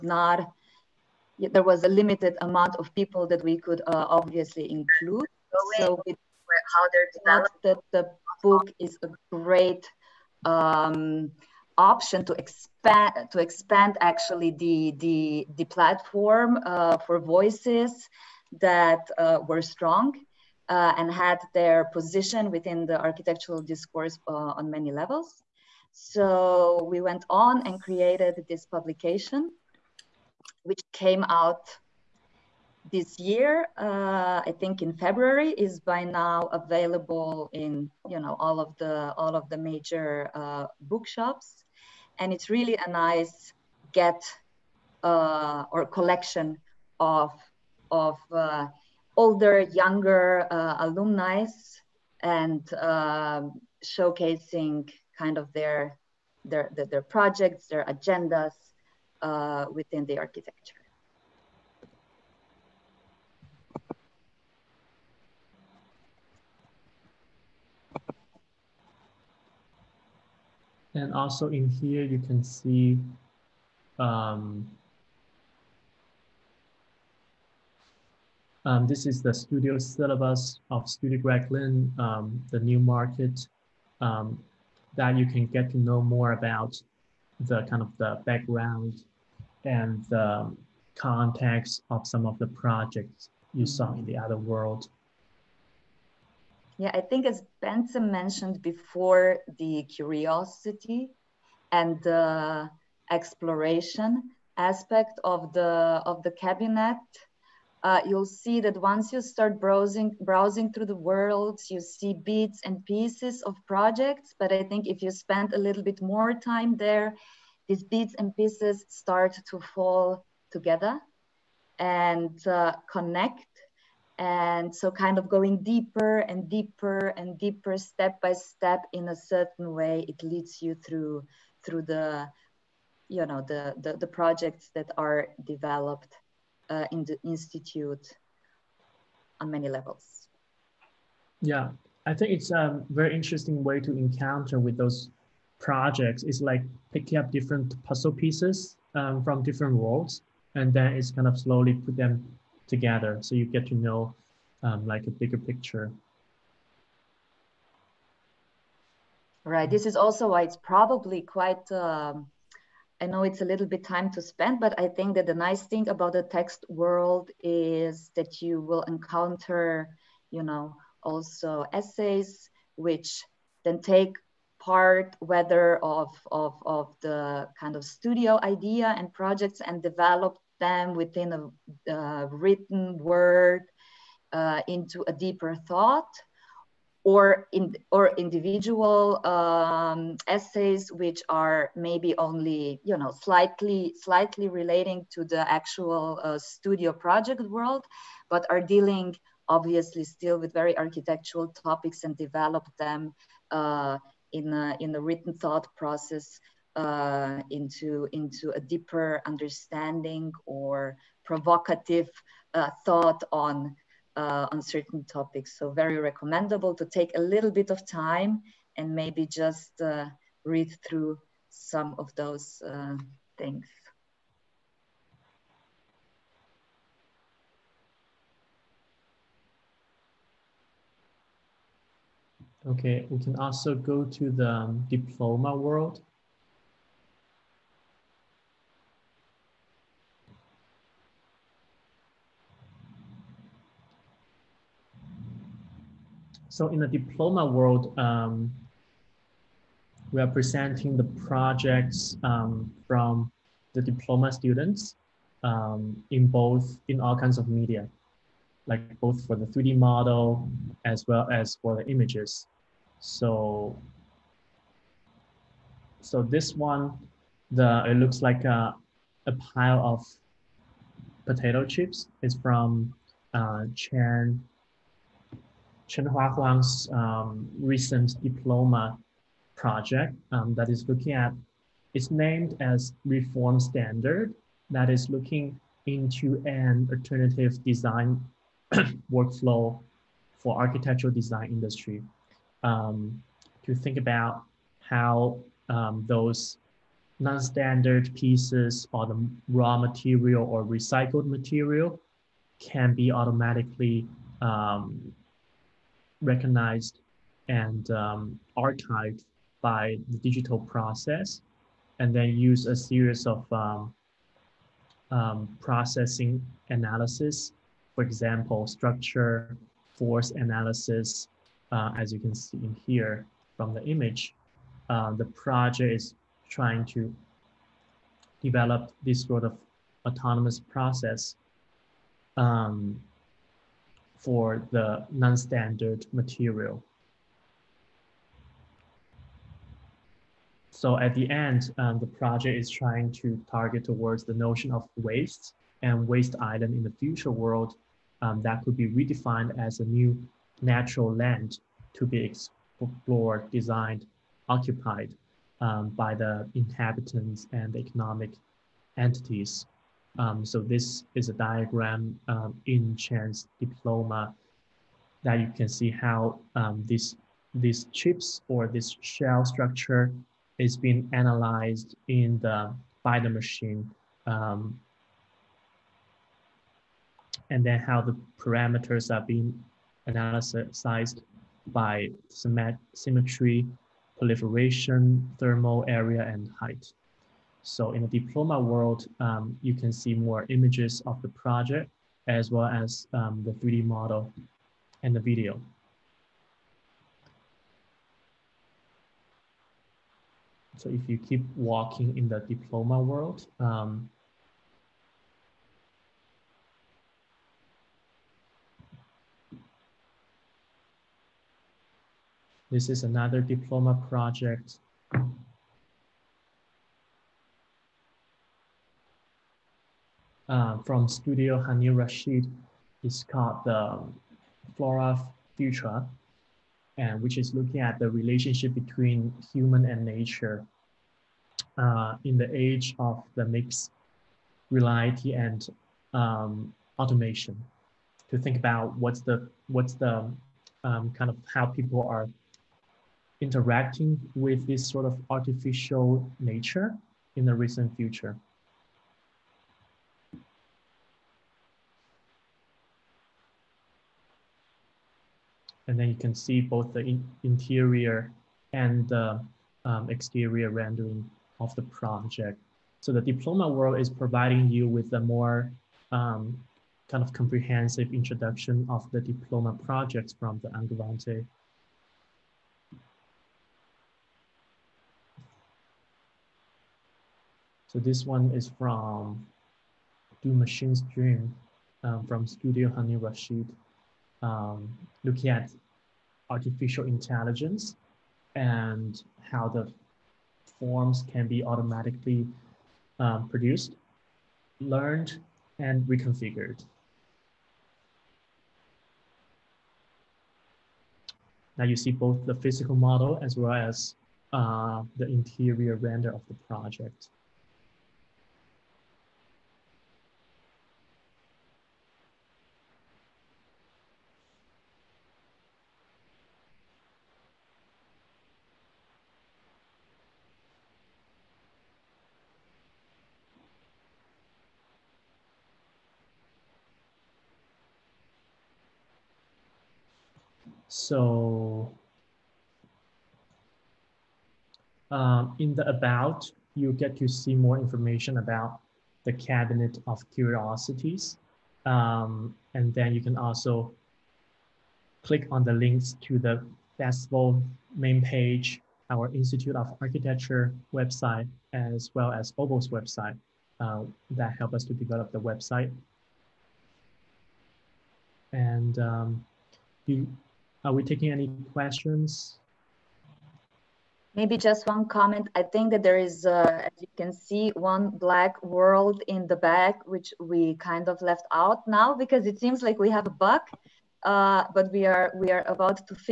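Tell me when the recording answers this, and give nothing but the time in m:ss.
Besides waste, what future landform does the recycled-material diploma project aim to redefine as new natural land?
5:46.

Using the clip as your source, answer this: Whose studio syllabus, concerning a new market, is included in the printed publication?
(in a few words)
Studio Greg.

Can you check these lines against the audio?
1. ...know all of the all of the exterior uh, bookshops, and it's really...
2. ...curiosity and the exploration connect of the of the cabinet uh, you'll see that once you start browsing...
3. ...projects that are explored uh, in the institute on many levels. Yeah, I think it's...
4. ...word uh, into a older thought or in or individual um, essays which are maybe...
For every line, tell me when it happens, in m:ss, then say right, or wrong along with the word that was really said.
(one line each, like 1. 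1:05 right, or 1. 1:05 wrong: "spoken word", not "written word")
1. 0:38 wrong: "major", not "exterior"
2. 1:39 wrong: "aspect", not "connect"
3. 2:14 wrong: "developed", not "explored"
4. 3:03 wrong: "deeper", not "older".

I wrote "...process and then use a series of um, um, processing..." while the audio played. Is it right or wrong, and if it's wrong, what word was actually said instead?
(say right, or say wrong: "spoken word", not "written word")
right.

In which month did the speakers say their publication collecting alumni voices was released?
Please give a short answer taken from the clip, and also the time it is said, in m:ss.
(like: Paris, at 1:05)
February, at 0:34.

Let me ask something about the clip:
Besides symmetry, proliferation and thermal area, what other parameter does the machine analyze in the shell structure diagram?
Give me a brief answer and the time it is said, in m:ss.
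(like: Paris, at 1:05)
Height, at 6:26.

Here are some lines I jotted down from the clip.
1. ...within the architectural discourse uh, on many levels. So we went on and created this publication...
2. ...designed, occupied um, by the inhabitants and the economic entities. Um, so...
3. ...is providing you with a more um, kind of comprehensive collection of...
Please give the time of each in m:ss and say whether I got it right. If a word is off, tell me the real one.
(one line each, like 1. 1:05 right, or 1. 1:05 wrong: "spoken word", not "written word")
1. 0:22 right
2. 5:53 right
3. 7:43 wrong: "introduction", not "collection".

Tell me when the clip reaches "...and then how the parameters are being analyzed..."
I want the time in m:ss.
6:17.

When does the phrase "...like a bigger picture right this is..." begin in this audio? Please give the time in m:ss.
2:34.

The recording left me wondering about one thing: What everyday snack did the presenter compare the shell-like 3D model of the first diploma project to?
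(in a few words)
Potato chips.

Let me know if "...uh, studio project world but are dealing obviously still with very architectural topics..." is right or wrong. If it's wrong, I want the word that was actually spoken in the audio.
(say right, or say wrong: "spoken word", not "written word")
right.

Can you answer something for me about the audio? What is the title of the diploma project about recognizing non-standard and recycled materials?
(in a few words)
Reform Standard.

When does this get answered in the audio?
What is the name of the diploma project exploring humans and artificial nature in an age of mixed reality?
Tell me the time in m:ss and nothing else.
7:04.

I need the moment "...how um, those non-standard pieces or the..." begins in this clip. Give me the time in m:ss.
4:54.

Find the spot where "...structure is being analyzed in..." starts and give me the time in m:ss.
6:09.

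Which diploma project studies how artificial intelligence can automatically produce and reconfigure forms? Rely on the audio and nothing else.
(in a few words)
Do Machines Dream.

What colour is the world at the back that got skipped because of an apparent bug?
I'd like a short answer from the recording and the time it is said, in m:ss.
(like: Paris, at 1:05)
Black, at 9:28.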